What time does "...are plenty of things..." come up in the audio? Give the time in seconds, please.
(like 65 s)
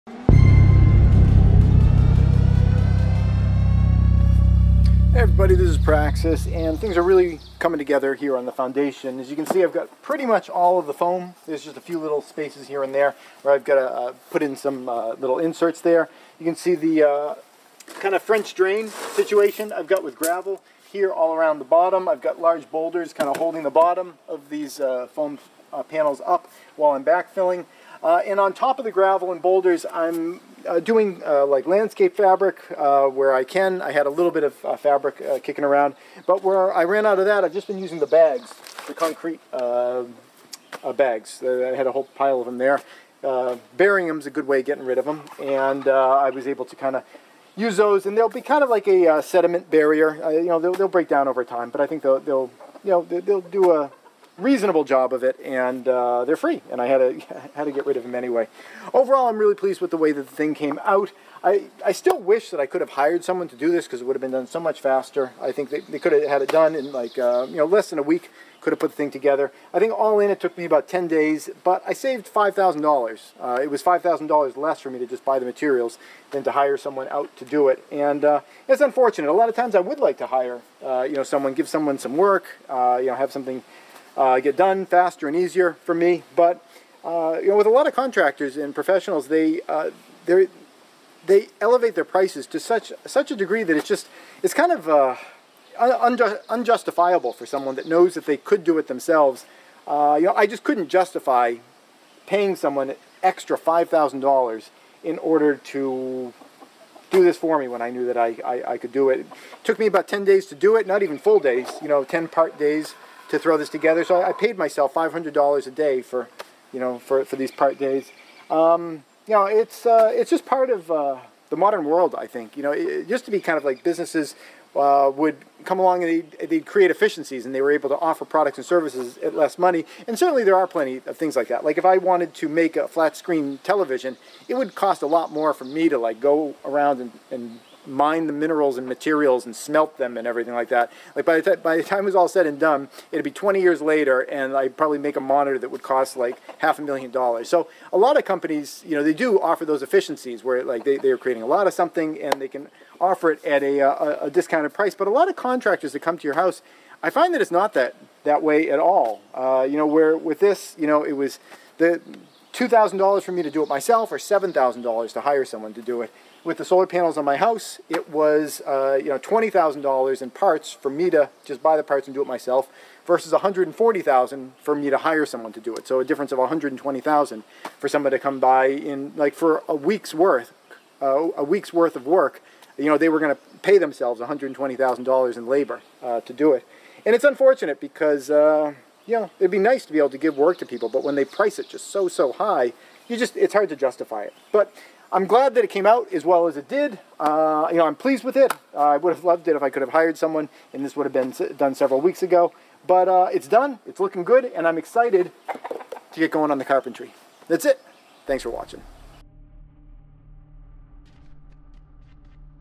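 130 s.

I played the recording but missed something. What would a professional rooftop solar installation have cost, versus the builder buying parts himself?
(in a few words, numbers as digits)
$140,000.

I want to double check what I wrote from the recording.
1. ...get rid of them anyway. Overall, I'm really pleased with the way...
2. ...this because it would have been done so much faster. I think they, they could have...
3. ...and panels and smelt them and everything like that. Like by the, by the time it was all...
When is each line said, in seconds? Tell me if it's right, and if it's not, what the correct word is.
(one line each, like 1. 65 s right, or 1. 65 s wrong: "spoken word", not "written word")
1. 57 s right
2. 63 s right
3. 138 s wrong: "materials", not "panels".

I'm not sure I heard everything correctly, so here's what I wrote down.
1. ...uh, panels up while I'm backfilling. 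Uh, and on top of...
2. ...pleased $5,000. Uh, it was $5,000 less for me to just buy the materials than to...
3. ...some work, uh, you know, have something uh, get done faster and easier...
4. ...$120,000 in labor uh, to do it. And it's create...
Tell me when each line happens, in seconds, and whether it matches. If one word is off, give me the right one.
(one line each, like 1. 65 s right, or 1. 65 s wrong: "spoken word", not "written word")
1. 25 s right
2. 71 s wrong: "saved", not "pleased"
3. 81 s right
4. 184 s wrong: "unfortunate", not "create".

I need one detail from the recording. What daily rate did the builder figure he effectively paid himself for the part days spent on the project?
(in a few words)
$500 a day.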